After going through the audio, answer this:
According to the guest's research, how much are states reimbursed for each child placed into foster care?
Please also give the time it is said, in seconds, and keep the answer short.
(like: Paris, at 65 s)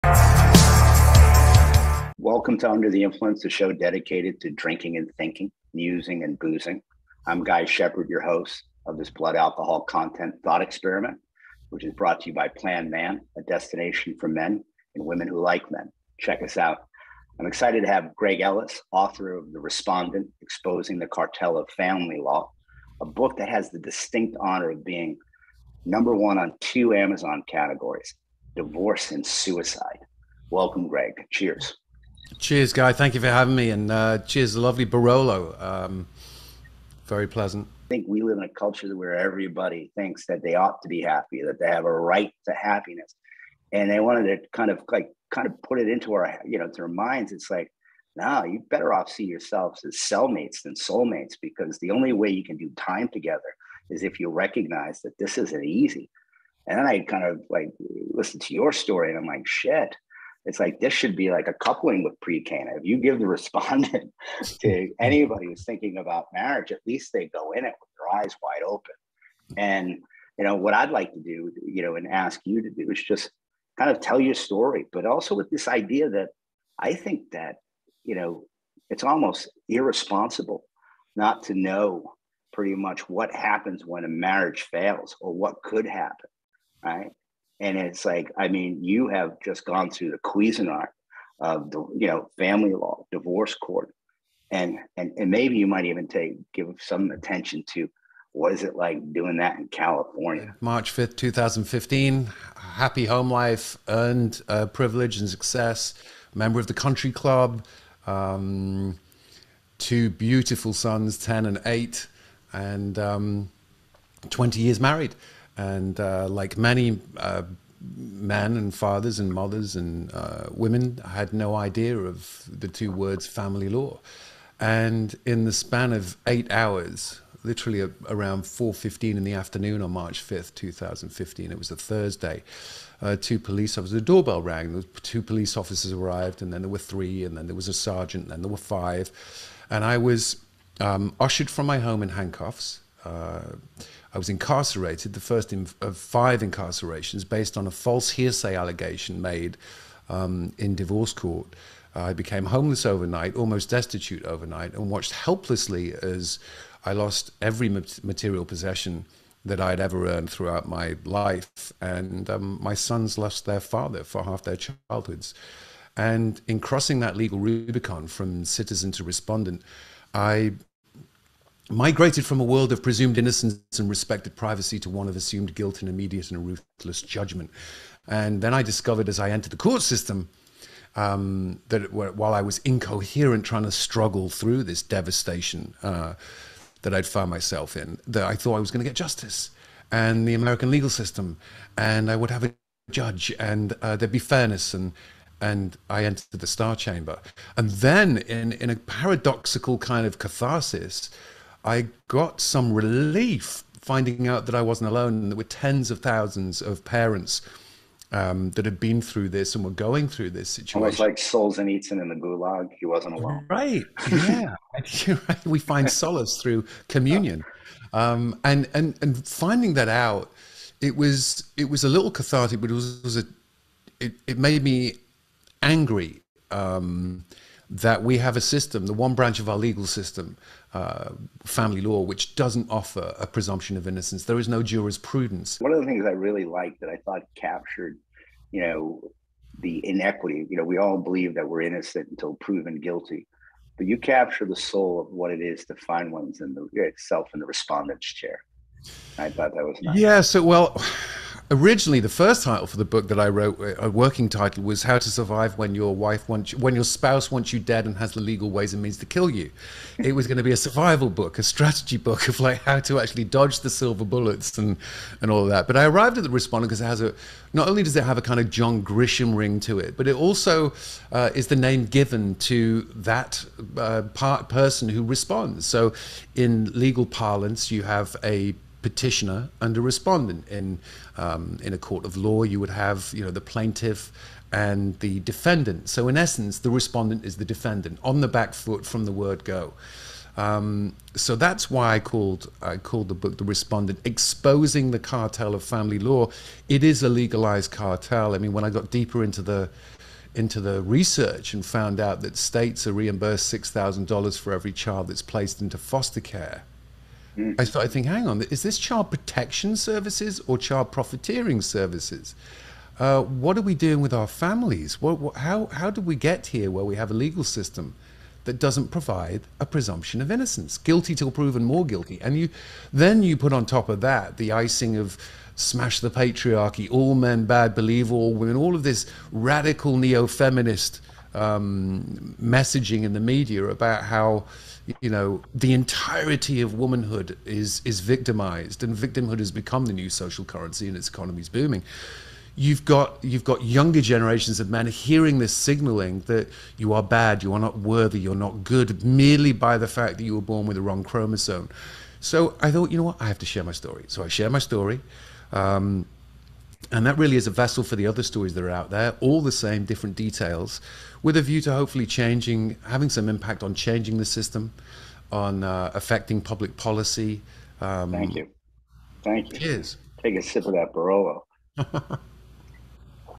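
$6,000, at 303 s.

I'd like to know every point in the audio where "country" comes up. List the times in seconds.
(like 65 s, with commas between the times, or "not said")
106 s.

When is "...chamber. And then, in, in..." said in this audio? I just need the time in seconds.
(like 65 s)
196 s.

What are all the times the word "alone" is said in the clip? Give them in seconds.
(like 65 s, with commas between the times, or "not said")
204 s, 213 s.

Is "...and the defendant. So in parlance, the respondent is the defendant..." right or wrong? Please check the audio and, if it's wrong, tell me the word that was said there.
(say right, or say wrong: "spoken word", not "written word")
wrong: "essence", not "parlance".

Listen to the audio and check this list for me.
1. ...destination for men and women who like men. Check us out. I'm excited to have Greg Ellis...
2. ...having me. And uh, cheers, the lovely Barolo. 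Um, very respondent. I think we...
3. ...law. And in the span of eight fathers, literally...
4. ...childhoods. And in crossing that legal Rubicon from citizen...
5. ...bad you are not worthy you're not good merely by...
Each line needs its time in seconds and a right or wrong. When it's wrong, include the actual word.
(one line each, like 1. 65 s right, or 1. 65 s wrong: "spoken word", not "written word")
1. 13 s right
2. 33 s wrong: "pleasant", not "respondent"
3. 123 s wrong: "hours", not "fathers"
4. 164 s right
5. 347 s right.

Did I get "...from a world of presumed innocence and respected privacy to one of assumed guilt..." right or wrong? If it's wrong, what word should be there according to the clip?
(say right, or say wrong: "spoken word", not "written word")
right.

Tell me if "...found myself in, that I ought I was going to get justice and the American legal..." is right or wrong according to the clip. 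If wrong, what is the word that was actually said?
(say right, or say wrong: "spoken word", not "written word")
wrong: "thought", not "ought".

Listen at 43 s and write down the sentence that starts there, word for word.
And they wanted to kind of like kind of put it into our, you know, to our minds.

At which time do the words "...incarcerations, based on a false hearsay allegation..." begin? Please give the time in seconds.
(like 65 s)
146 s.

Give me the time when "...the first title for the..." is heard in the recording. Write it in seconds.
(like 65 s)
251 s.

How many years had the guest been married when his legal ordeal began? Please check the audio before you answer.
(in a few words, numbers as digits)
20.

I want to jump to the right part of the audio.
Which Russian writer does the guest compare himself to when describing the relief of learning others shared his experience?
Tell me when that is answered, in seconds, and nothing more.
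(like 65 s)
211 s.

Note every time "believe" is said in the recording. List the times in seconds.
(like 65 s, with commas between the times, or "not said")
240 s, 327 s.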